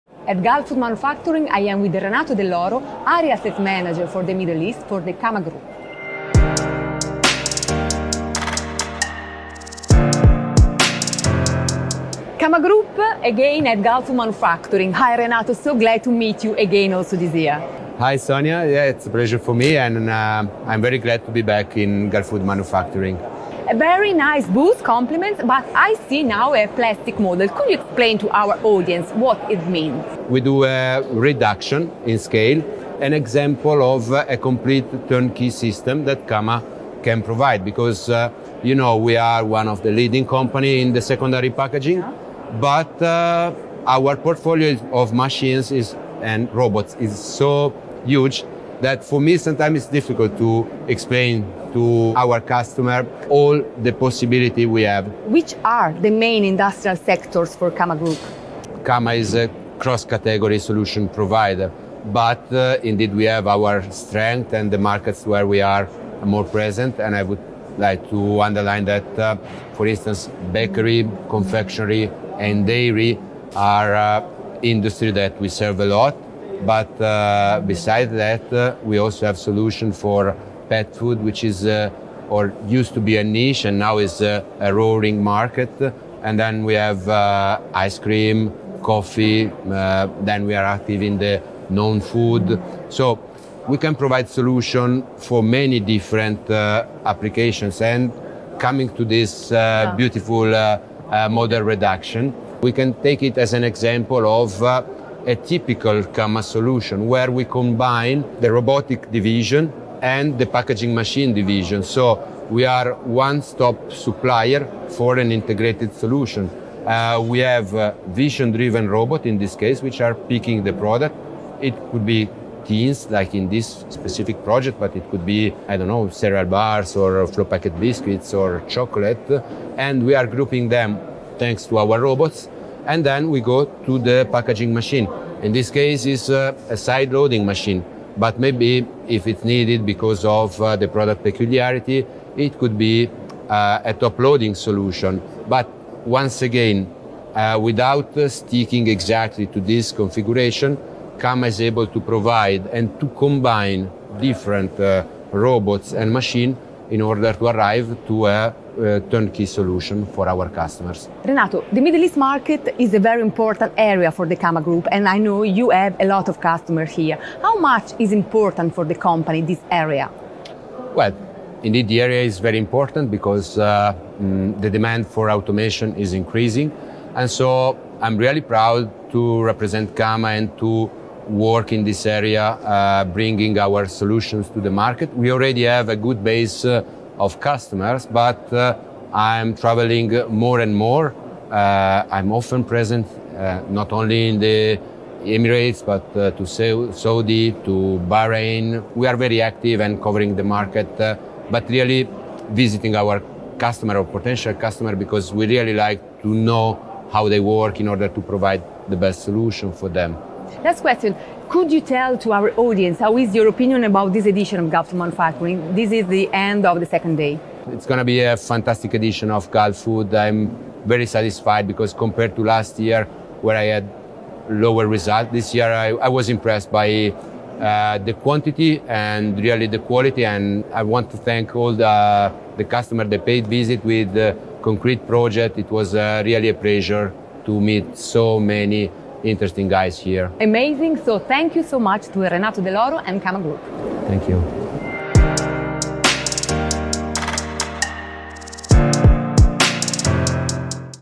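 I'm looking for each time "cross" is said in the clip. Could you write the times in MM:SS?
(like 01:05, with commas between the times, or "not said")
00:59.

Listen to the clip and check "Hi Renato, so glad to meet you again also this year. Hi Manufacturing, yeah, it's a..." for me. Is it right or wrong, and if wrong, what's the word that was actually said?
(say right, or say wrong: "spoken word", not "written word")
wrong: "Sonia", not "Manufacturing".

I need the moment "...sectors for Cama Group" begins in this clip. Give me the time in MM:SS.
00:56.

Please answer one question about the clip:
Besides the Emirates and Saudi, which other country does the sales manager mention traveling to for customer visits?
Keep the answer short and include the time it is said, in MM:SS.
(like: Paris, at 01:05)
Bahrain, at 03:18.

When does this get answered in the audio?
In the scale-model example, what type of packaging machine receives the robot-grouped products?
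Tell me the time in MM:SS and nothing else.
02:16.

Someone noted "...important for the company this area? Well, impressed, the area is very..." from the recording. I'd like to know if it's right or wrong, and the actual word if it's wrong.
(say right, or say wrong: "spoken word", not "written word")
wrong: "indeed", not "impressed".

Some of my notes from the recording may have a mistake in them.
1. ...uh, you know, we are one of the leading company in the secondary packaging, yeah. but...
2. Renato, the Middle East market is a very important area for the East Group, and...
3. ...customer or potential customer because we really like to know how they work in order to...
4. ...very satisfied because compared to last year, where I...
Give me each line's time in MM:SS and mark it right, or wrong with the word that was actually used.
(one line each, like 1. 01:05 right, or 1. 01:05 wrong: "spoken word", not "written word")
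1. 00:38 right
2. 02:41 wrong: "Cama", not "East"
3. 03:23 right
4. 03:40 right.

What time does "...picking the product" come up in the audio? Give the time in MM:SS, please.
02:00.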